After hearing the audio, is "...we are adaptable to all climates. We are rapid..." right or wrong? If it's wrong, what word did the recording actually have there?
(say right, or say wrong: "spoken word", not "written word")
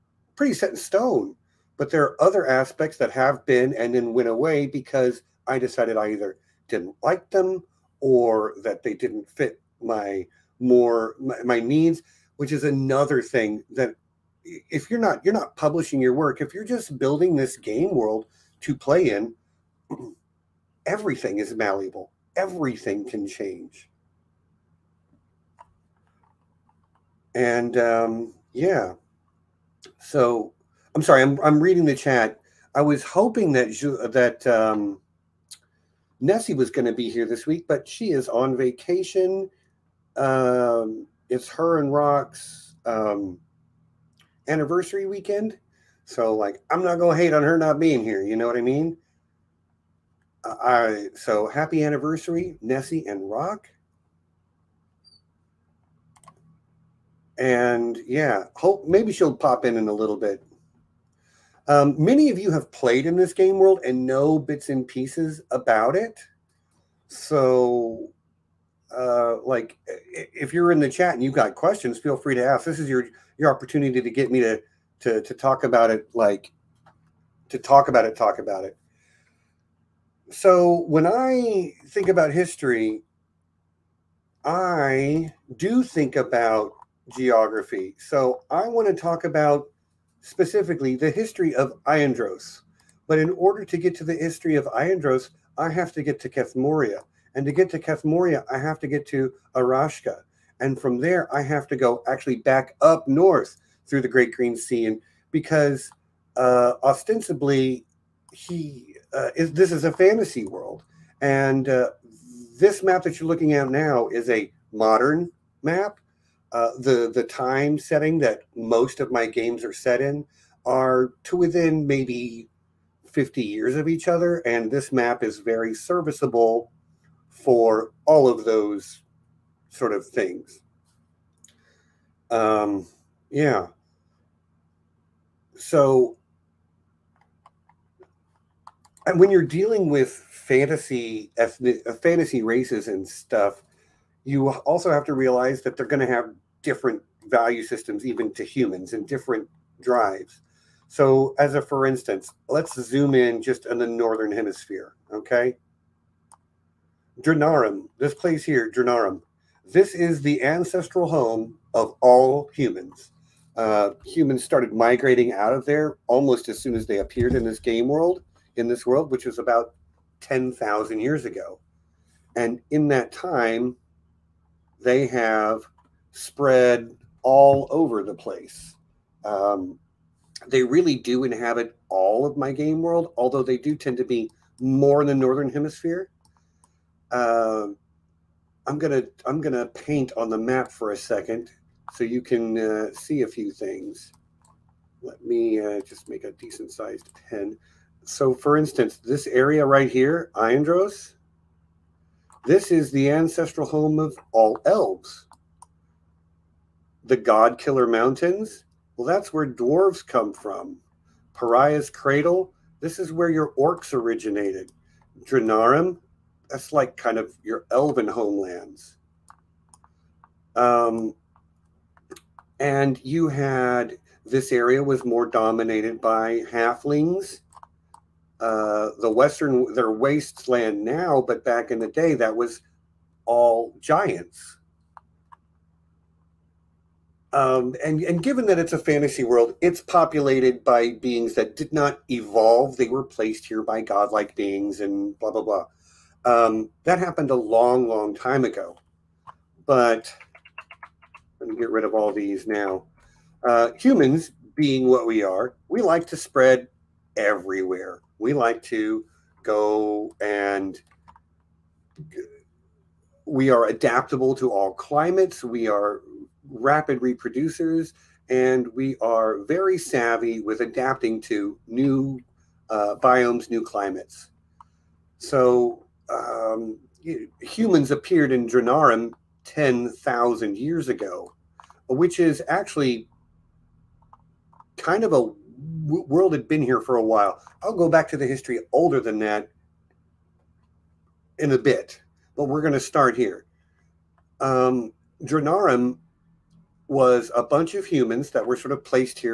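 right.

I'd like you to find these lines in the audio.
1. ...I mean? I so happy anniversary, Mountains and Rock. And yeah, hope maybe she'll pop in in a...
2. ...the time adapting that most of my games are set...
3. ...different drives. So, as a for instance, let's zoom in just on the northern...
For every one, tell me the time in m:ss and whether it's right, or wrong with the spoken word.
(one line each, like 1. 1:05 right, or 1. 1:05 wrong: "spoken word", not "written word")
1. 0:48 wrong: "Nessie", not "Mountains"
2. 1:57 wrong: "setting", not "adapting"
3. 2:29 right.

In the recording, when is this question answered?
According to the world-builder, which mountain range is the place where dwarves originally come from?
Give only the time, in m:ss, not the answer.
3:27.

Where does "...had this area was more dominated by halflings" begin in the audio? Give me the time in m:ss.
3:43.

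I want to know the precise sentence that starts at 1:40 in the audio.
And from there, I have to go actually back up north through the Great Green Sea.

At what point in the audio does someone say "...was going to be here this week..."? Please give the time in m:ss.
0:36.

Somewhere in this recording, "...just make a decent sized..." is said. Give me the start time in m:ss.
3:15.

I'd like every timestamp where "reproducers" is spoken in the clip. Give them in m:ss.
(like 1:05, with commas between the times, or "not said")
4:26.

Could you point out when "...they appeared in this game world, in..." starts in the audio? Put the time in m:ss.
2:46.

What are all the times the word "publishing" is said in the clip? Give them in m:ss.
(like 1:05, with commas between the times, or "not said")
0:15.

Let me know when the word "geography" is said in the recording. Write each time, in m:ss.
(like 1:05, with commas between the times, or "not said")
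1:27.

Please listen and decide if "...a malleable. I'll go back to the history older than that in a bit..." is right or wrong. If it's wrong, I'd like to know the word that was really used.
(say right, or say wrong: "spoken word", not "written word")
wrong: "while", not "malleable".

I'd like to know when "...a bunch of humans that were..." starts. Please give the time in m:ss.
4:57.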